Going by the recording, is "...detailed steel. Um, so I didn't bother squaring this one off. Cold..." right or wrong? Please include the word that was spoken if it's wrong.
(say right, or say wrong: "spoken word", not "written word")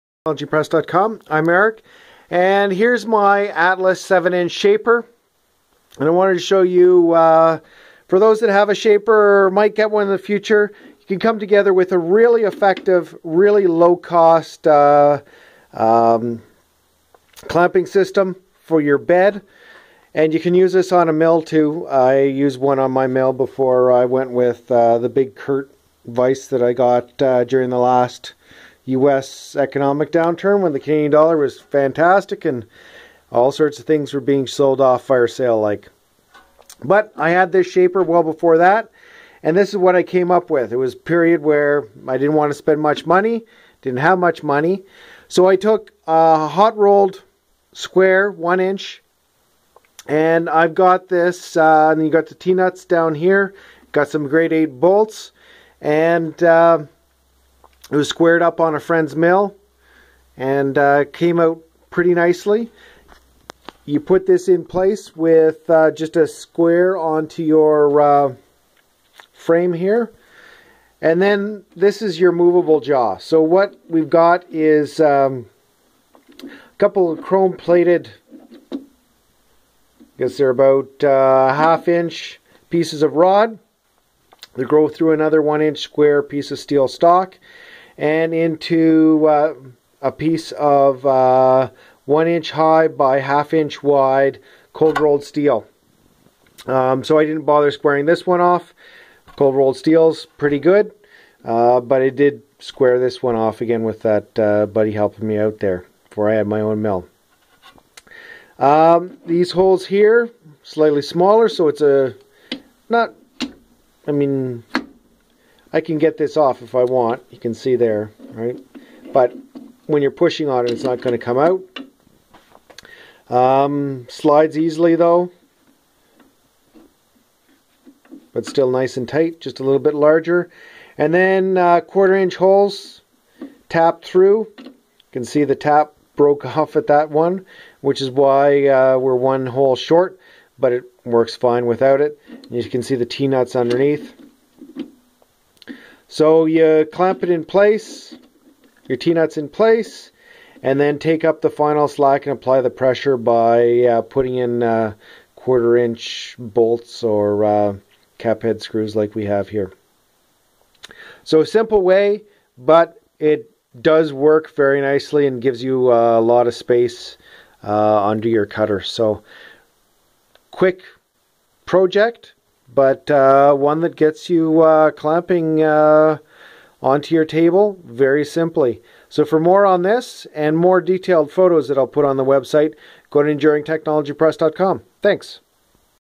wrong: "rolled", not "detailed".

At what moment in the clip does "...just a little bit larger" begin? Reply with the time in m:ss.
2:09.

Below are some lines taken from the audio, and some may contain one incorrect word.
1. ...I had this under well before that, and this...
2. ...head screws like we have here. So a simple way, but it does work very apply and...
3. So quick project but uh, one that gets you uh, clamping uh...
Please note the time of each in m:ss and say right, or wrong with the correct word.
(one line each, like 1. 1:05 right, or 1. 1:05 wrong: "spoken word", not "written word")
1. 0:37 wrong: "shaper", not "under"
2. 2:38 wrong: "nicely", not "apply"
3. 2:48 right.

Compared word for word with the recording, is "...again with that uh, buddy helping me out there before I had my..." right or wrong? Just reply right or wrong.
right.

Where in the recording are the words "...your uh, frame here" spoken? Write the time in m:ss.
1:07.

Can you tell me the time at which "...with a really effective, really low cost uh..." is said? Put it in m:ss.
0:11.